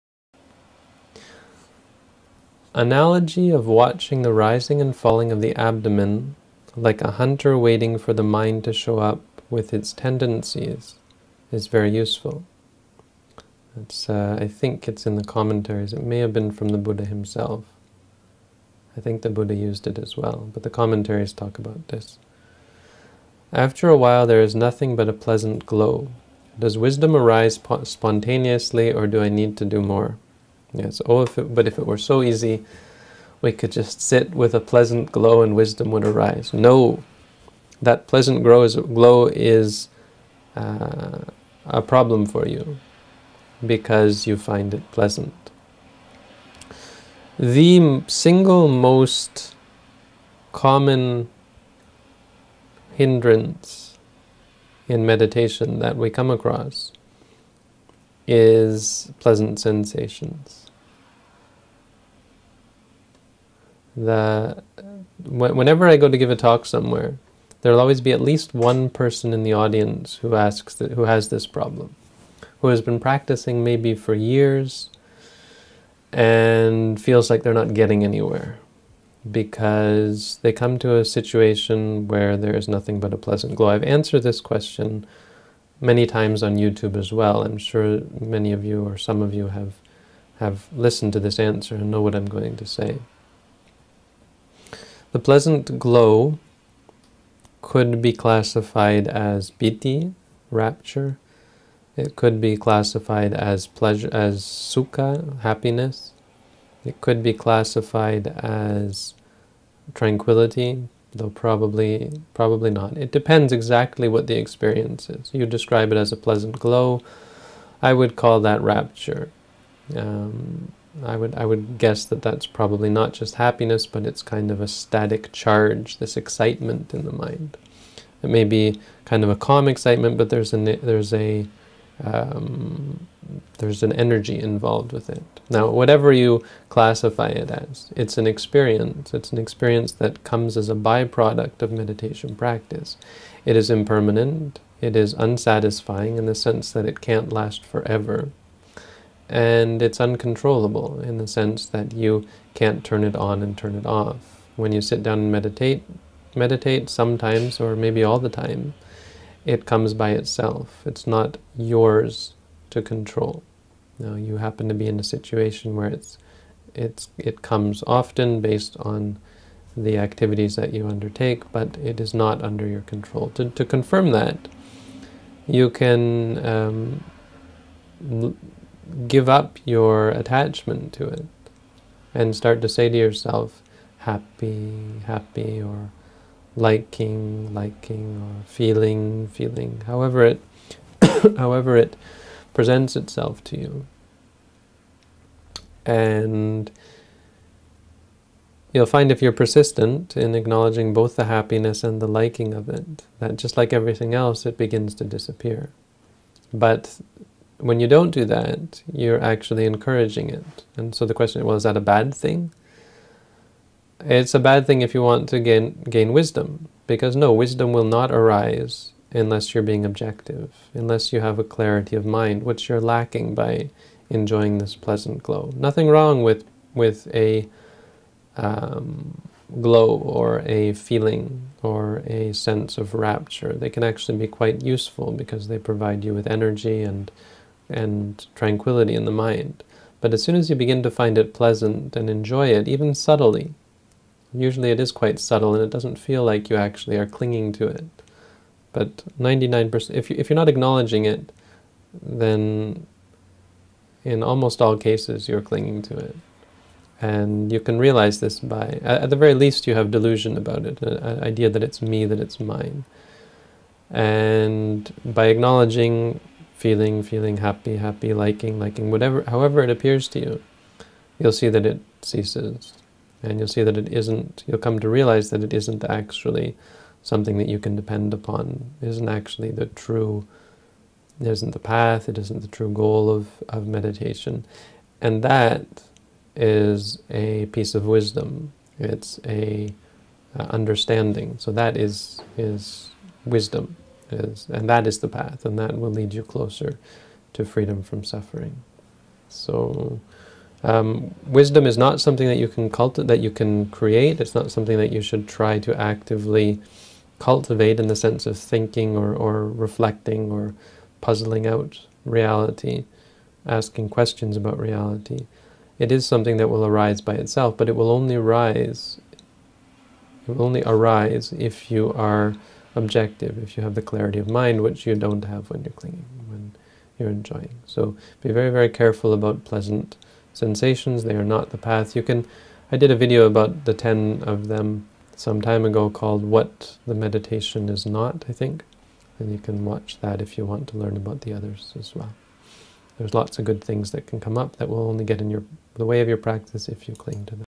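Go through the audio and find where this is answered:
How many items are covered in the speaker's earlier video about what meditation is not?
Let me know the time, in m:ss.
5:33.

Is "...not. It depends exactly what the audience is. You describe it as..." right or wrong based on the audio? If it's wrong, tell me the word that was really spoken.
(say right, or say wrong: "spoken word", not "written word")
wrong: "experience", not "audience".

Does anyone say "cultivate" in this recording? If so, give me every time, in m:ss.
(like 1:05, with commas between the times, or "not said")
5:02, 5:07.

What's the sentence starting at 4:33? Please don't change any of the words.
And you'll see that it isn't, you'll come to realize that it isn't actually something that you can depend upon.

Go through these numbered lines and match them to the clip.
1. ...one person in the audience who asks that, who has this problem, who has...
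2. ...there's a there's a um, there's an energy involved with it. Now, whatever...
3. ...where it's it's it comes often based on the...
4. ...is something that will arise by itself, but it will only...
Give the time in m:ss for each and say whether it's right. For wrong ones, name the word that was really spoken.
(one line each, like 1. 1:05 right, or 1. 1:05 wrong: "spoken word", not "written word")
1. 1:08 right
2. 2:10 right
3. 2:45 right
4. 5:15 right.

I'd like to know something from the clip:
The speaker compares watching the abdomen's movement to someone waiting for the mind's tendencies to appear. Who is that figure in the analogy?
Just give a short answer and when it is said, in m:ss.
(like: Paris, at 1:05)
a hunter, at 0:07.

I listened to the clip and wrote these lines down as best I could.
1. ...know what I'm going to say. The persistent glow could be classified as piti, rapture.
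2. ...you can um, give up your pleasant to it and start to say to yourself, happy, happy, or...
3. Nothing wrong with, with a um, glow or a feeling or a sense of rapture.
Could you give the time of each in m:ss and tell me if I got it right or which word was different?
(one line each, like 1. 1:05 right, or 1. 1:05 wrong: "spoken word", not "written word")
1. 1:31 wrong: "pleasant", not "persistent"
2. 2:55 wrong: "attachment", not "pleasant"
3. 3:45 right.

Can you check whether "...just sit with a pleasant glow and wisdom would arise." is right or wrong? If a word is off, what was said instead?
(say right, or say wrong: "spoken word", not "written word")
right.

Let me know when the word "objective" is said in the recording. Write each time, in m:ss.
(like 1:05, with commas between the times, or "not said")
3:39, 5:22.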